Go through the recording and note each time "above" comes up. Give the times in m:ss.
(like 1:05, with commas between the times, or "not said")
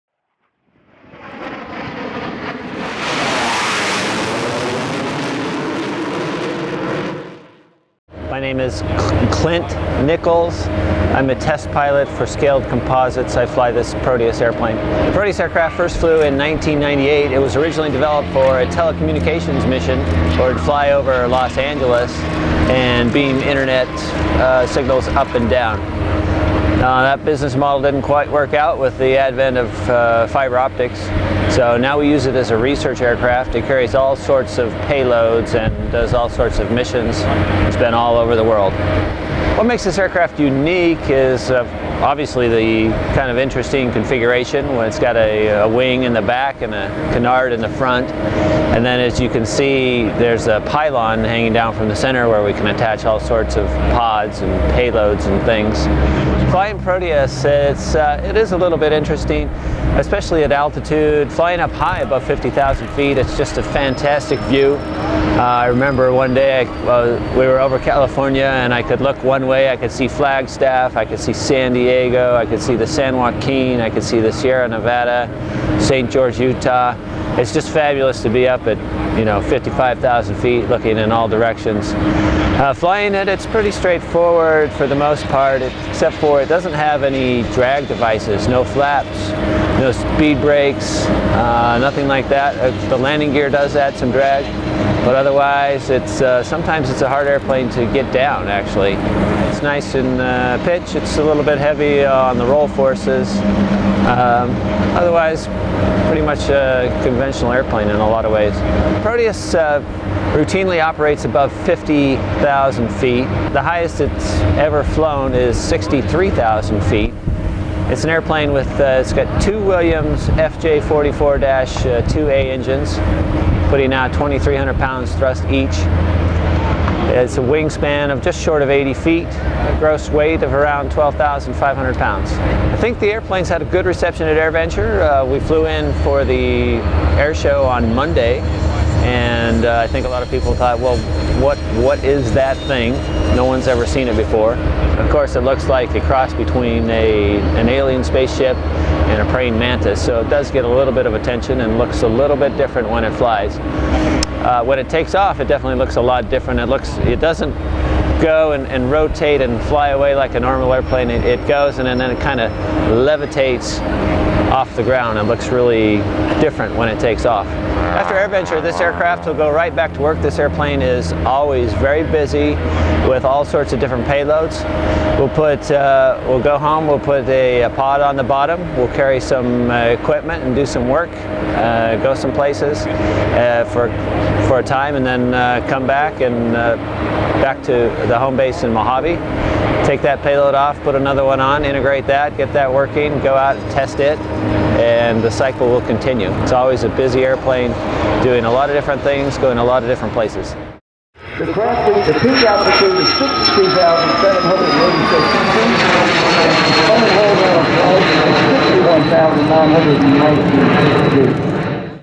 1:01, 1:51.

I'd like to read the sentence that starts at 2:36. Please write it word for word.
It looks, it doesn't go and, and, rotate and fly away like a normal airplane.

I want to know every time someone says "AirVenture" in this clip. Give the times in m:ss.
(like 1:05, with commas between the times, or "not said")
2:14, 2:48.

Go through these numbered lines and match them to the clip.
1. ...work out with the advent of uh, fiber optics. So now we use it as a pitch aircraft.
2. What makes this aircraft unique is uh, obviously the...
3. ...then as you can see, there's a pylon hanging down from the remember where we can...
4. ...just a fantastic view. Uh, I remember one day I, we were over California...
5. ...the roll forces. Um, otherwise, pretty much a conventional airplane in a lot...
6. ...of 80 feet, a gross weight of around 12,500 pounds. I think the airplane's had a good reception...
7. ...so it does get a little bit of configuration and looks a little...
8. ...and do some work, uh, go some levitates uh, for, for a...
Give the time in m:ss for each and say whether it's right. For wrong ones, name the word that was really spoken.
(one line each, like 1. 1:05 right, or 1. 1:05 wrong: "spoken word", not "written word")
1. 0:28 wrong: "research", not "pitch"
2. 0:39 right
3. 0:48 wrong: "center", not "remember"
4. 1:03 right
5. 1:42 right
6. 2:08 right
7. 2:30 wrong: "attention", not "configuration"
8. 3:00 wrong: "places", not "levitates".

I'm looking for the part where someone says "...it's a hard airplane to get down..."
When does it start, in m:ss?
1:36.